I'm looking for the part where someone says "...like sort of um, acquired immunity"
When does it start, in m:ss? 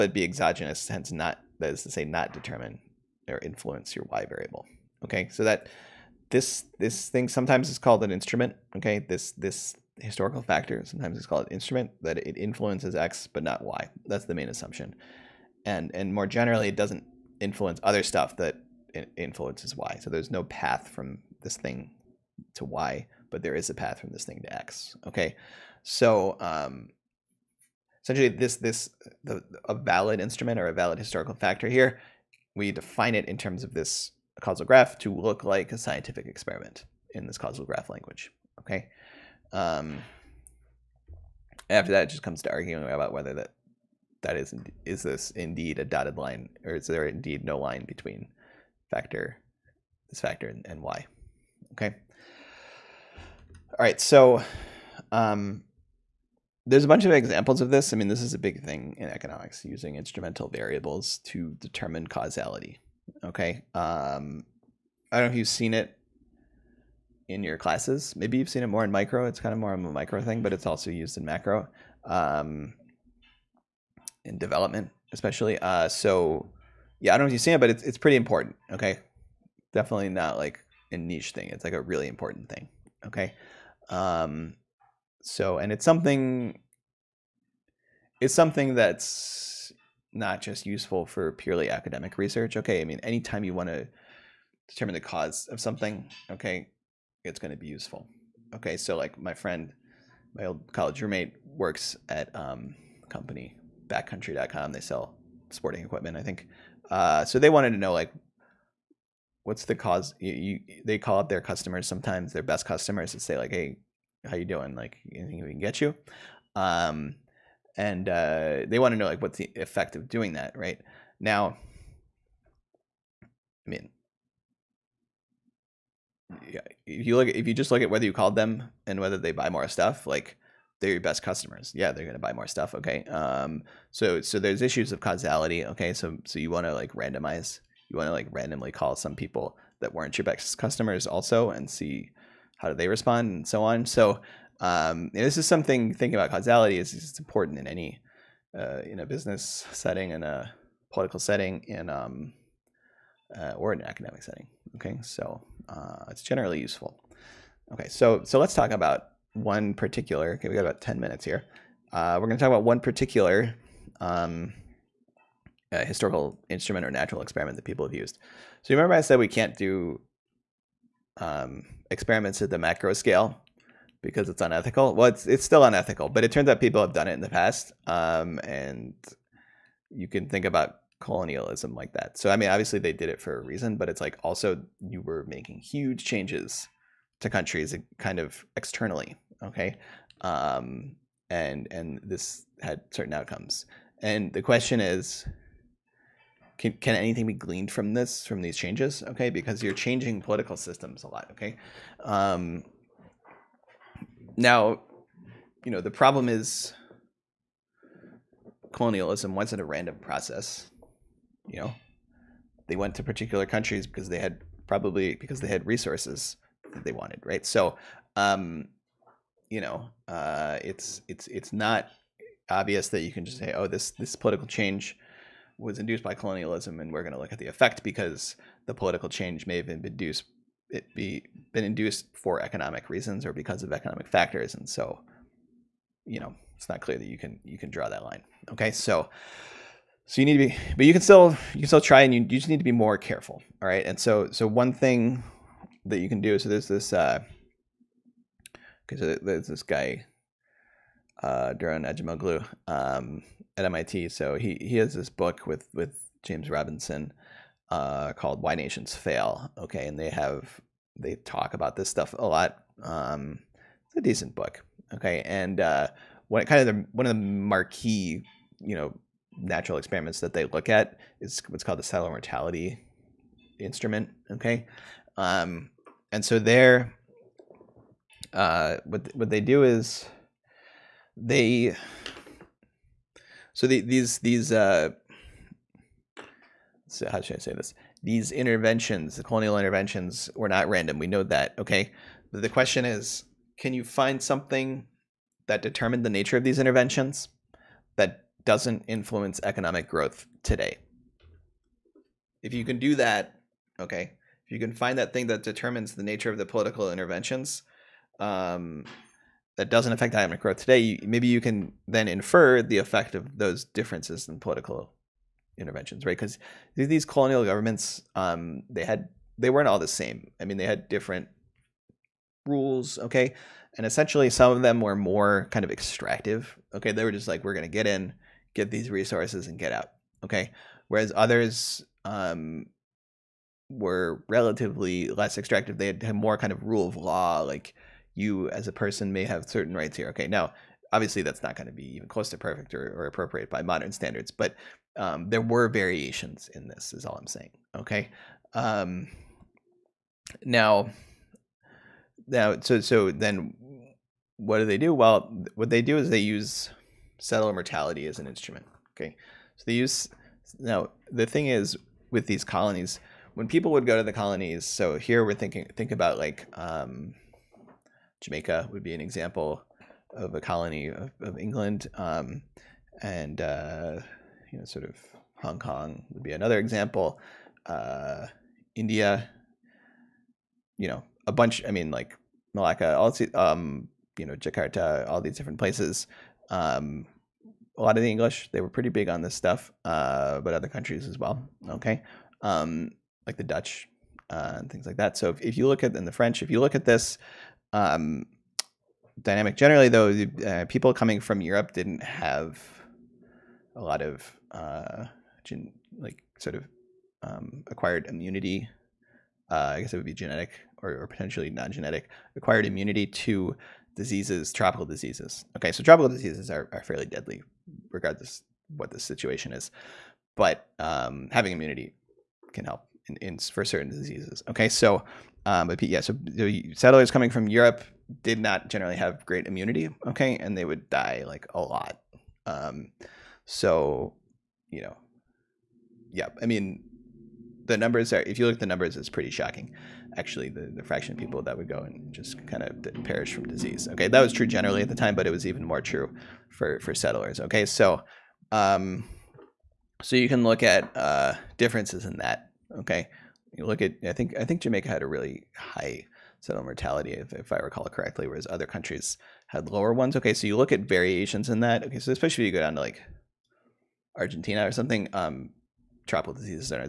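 6:45.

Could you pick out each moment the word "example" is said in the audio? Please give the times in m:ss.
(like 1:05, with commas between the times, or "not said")
0:57, 6:08, 6:16.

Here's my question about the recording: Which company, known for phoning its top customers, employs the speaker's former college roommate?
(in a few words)
backcountry.com.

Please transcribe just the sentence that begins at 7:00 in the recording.
But um, having immunity can help in, in, for certain diseases.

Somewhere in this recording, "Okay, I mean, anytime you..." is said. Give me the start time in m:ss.
1:32.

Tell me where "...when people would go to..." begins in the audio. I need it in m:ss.
6:03.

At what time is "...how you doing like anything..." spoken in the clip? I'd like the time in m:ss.
1:54.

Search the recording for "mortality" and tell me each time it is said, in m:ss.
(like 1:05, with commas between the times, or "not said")
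4:32, 5:57, 7:36.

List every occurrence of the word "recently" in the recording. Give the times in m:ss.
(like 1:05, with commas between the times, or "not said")
not said.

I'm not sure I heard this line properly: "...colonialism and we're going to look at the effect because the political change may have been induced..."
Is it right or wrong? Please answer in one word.
right.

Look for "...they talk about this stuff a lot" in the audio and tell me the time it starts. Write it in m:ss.
4:20.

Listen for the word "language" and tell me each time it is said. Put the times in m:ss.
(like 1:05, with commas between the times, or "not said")
0:37.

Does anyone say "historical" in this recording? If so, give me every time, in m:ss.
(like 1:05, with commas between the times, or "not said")
0:10, 0:30, 2:45.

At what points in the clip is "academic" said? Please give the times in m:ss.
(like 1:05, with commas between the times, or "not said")
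1:31, 2:33.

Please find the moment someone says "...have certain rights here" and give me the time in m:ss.
5:39.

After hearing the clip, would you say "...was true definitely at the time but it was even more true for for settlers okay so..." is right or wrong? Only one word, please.
wrong.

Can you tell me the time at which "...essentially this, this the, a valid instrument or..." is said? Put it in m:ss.
0:28.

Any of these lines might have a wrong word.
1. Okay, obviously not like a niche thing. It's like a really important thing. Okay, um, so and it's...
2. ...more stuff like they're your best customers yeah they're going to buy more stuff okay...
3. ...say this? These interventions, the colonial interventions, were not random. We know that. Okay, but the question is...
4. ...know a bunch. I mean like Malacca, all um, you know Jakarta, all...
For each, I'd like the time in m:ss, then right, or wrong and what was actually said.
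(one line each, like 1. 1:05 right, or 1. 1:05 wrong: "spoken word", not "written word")
1. 1:18 wrong: "definitely", not "obviously"
2. 2:09 right
3. 4:47 right
4. 6:20 right.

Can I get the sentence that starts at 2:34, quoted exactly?
Okay, so uh, it's generally useful.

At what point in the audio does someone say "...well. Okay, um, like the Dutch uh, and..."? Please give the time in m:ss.
6:31.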